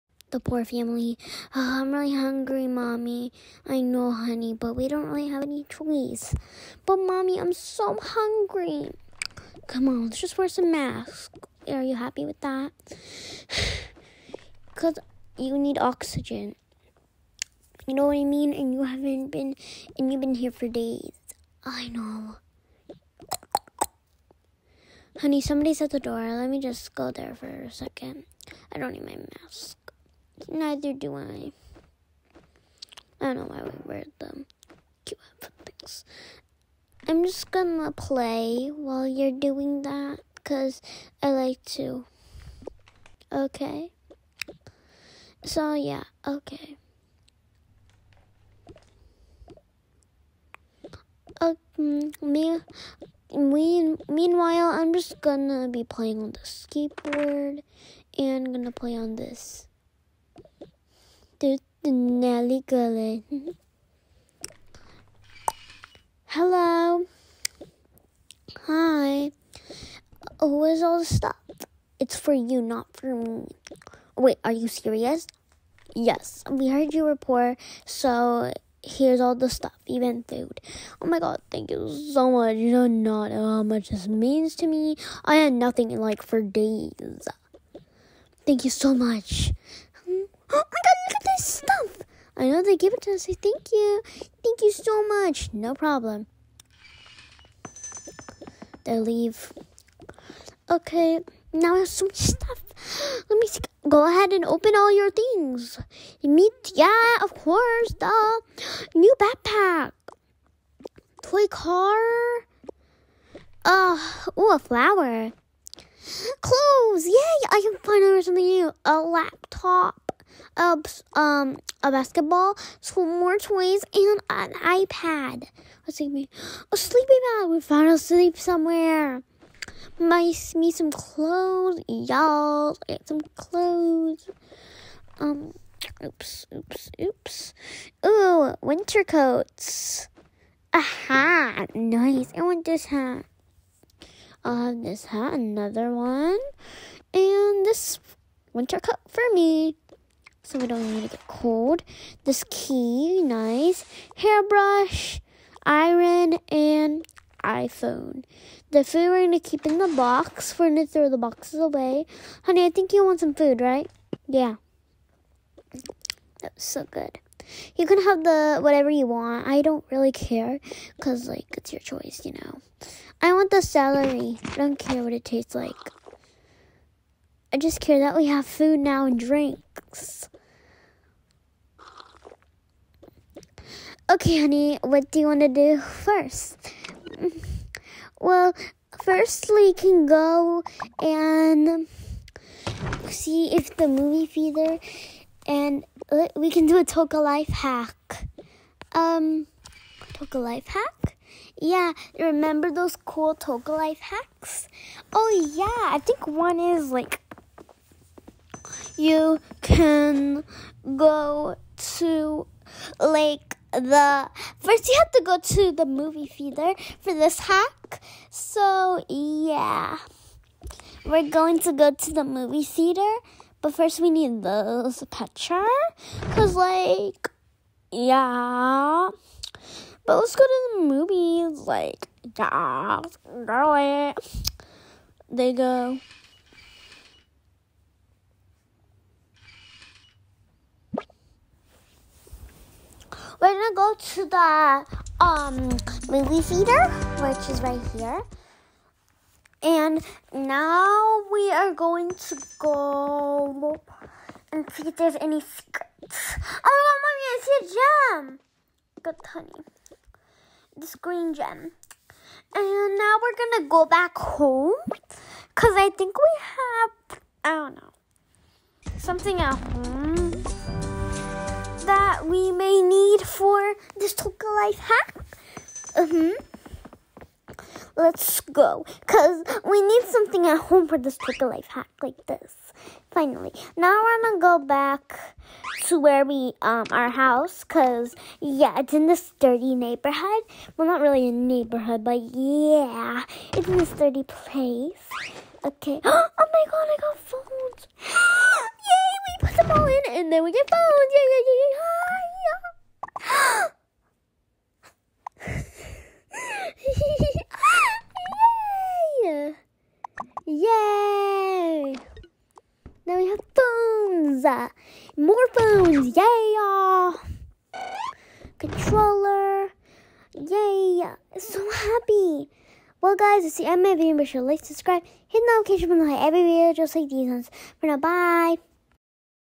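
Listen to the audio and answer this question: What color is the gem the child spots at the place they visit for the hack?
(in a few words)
green.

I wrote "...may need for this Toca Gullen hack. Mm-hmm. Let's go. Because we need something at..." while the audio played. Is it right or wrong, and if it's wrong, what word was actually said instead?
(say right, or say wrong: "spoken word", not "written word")
wrong: "Life", not "Gullen".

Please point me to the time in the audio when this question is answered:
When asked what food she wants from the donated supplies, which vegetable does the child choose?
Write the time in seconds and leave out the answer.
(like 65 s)
173 s.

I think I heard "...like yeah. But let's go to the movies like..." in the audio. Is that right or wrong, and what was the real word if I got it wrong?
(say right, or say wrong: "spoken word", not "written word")
right.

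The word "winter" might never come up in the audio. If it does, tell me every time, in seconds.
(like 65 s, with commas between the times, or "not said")
138 s, 148 s.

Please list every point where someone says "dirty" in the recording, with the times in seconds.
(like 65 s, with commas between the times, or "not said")
289 s, 293 s.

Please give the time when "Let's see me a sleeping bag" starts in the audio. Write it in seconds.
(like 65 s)
125 s.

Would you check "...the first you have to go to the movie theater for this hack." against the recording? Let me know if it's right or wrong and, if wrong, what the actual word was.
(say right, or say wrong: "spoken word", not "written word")
right.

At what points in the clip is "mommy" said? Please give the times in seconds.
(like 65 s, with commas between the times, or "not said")
2 s, 6 s, 257 s.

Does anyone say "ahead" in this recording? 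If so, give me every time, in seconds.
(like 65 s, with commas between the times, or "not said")
104 s.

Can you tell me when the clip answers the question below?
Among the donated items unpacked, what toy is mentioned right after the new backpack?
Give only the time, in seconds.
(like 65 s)
111 s.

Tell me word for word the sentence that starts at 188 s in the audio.
Well, first we can go and see if the movie theater and uh, we can do a Toca life hack.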